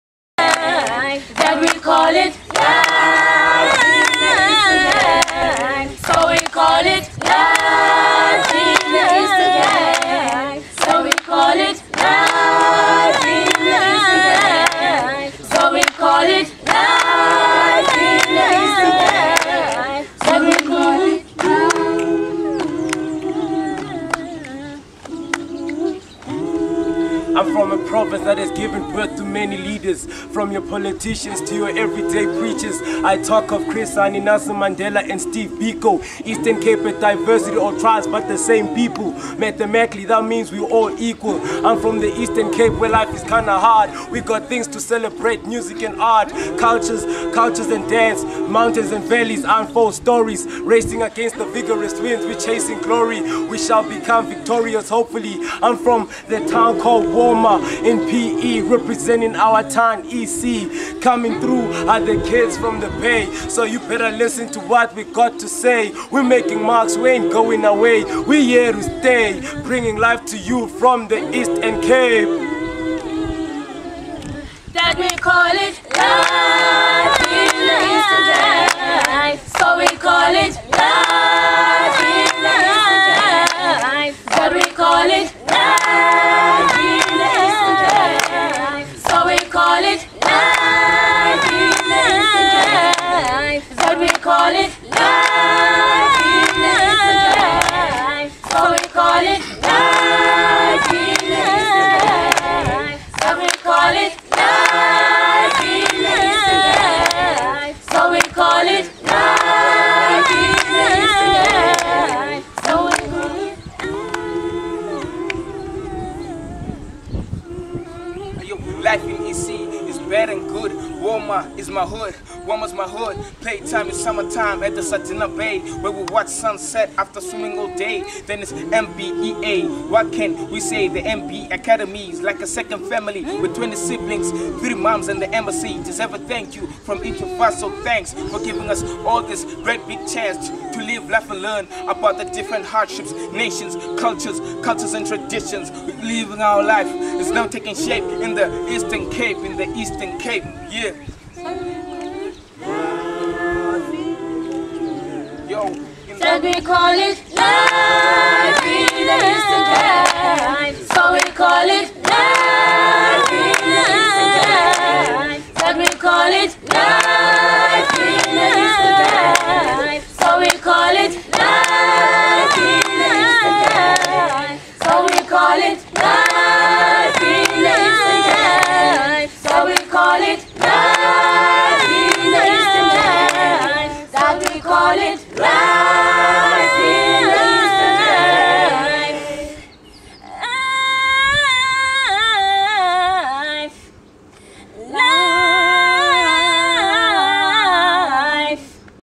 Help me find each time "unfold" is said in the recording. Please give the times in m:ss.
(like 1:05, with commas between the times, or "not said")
0:49.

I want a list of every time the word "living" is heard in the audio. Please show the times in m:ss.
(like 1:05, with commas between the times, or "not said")
2:26.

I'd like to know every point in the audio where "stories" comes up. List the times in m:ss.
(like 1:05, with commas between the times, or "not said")
0:49.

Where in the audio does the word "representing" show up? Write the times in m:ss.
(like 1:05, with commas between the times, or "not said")
0:58.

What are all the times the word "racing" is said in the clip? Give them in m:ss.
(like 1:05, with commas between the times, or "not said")
0:50.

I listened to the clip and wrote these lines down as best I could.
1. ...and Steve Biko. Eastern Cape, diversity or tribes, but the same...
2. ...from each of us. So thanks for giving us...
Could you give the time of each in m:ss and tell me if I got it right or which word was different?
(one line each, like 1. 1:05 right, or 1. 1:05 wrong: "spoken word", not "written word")
1. 0:35 right
2. 2:16 right.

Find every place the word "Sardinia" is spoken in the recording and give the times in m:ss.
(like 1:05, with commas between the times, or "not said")
2:04.